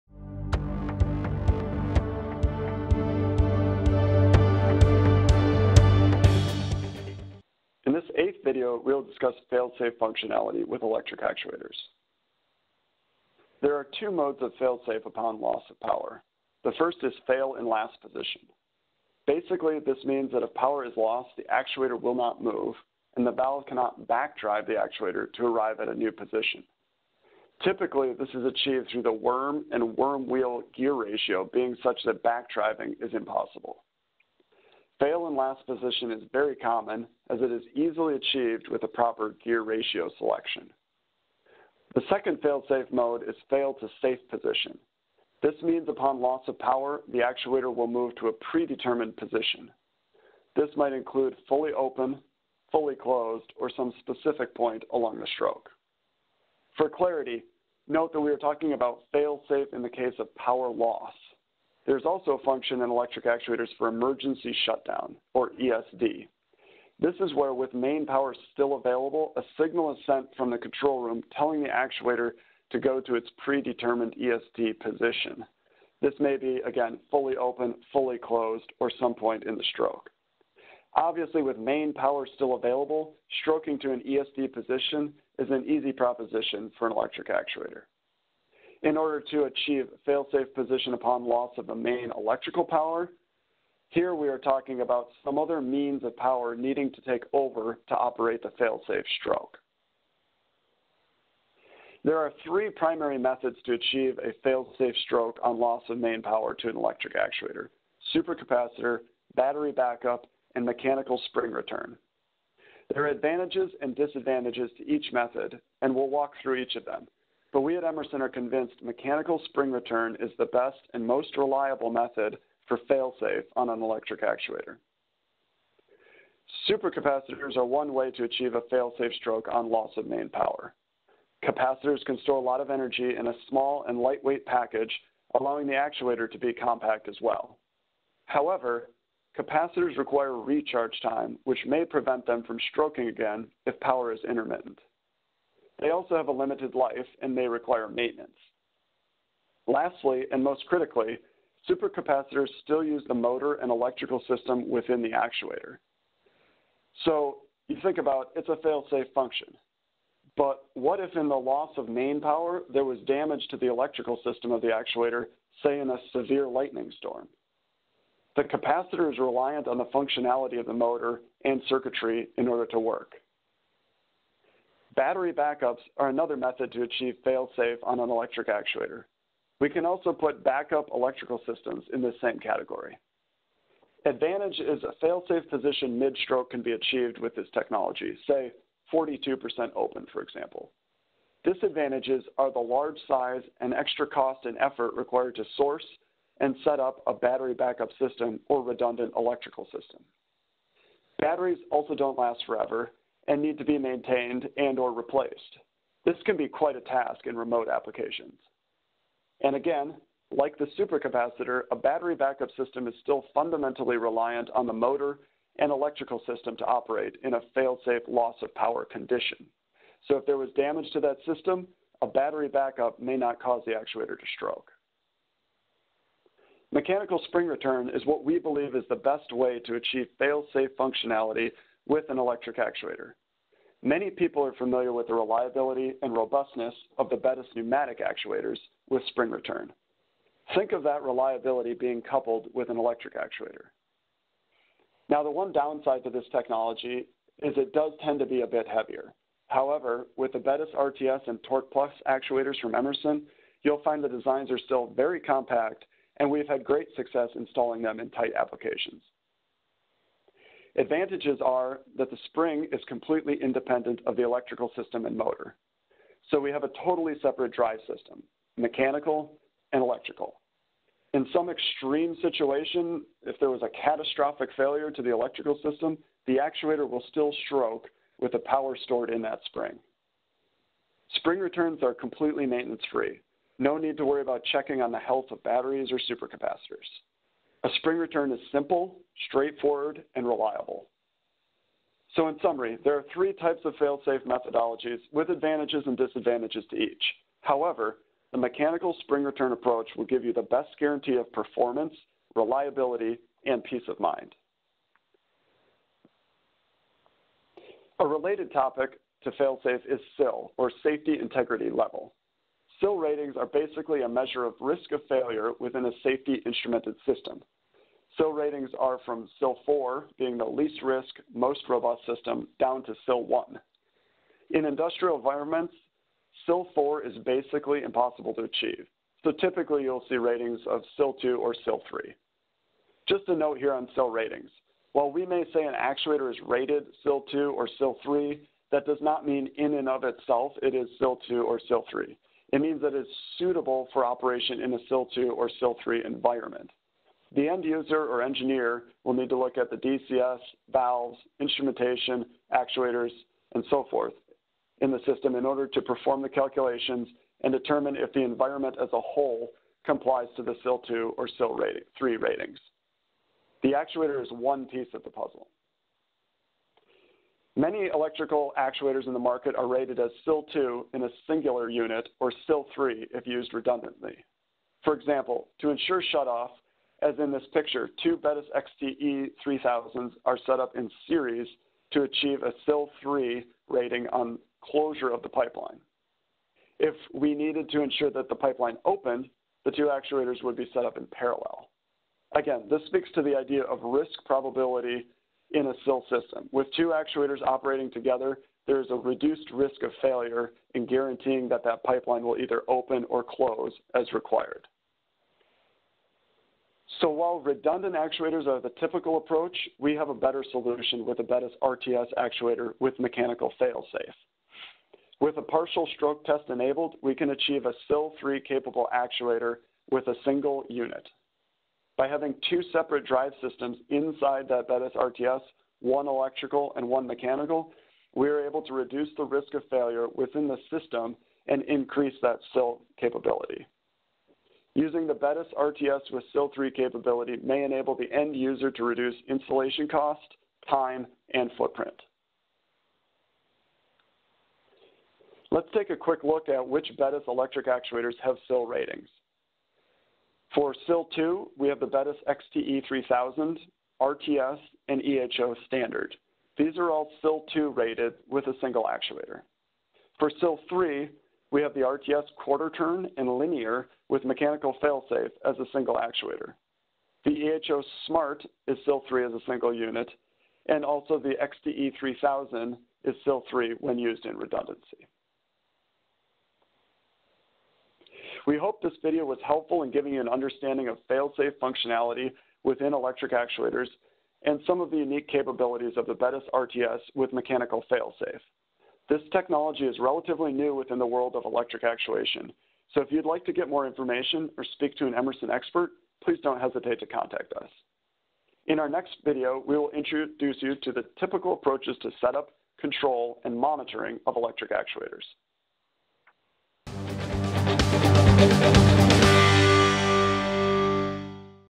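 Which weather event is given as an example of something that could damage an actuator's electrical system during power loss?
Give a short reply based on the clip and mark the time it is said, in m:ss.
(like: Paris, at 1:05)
severe lightning storm, at 2:46.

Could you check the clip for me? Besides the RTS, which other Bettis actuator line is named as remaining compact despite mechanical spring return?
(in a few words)
TorqPlus.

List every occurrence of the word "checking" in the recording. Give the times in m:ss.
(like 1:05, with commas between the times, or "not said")
4:44.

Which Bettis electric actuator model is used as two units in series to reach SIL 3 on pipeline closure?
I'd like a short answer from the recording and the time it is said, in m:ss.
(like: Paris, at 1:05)
XTE 3000, at 6:18.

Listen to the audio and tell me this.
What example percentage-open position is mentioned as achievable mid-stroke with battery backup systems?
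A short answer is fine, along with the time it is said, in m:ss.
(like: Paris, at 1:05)
42%, at 3:08.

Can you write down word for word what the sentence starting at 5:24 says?
In industrial environments, SIL 4 is basically impossible to achieve, so typically you'll see ratings of SIL 2 or SIL 3.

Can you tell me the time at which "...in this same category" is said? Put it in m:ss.
3:01.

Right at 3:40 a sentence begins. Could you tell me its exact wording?
So if there was damage to that system, a battery backup may not cause the actuator to stroke.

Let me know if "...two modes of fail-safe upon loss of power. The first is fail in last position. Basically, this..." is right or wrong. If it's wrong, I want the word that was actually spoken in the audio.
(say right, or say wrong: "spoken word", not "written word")
right.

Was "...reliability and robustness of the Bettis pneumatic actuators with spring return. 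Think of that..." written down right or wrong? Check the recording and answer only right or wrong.
right.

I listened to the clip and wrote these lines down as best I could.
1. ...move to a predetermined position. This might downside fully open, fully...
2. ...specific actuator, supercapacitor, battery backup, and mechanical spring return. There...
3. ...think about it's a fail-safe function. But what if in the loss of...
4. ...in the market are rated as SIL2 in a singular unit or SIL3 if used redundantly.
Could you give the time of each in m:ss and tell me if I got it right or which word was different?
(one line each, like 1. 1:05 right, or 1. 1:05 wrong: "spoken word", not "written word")
1. 0:47 wrong: "include", not "downside"
2. 1:46 wrong: "electric", not "specific"
3. 2:37 right
4. 6:09 right.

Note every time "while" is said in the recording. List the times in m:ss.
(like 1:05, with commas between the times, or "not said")
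5:34, 6:47.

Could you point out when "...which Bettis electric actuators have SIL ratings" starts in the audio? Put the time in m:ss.
7:26.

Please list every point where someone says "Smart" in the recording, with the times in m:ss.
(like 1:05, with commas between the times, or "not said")
7:48.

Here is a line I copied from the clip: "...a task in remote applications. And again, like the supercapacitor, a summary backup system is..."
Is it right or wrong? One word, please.
wrong.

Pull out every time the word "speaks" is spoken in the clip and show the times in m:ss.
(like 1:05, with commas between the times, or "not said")
6:32, 8:14.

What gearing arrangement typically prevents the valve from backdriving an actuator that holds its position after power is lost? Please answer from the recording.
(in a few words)
worm and worm wheel.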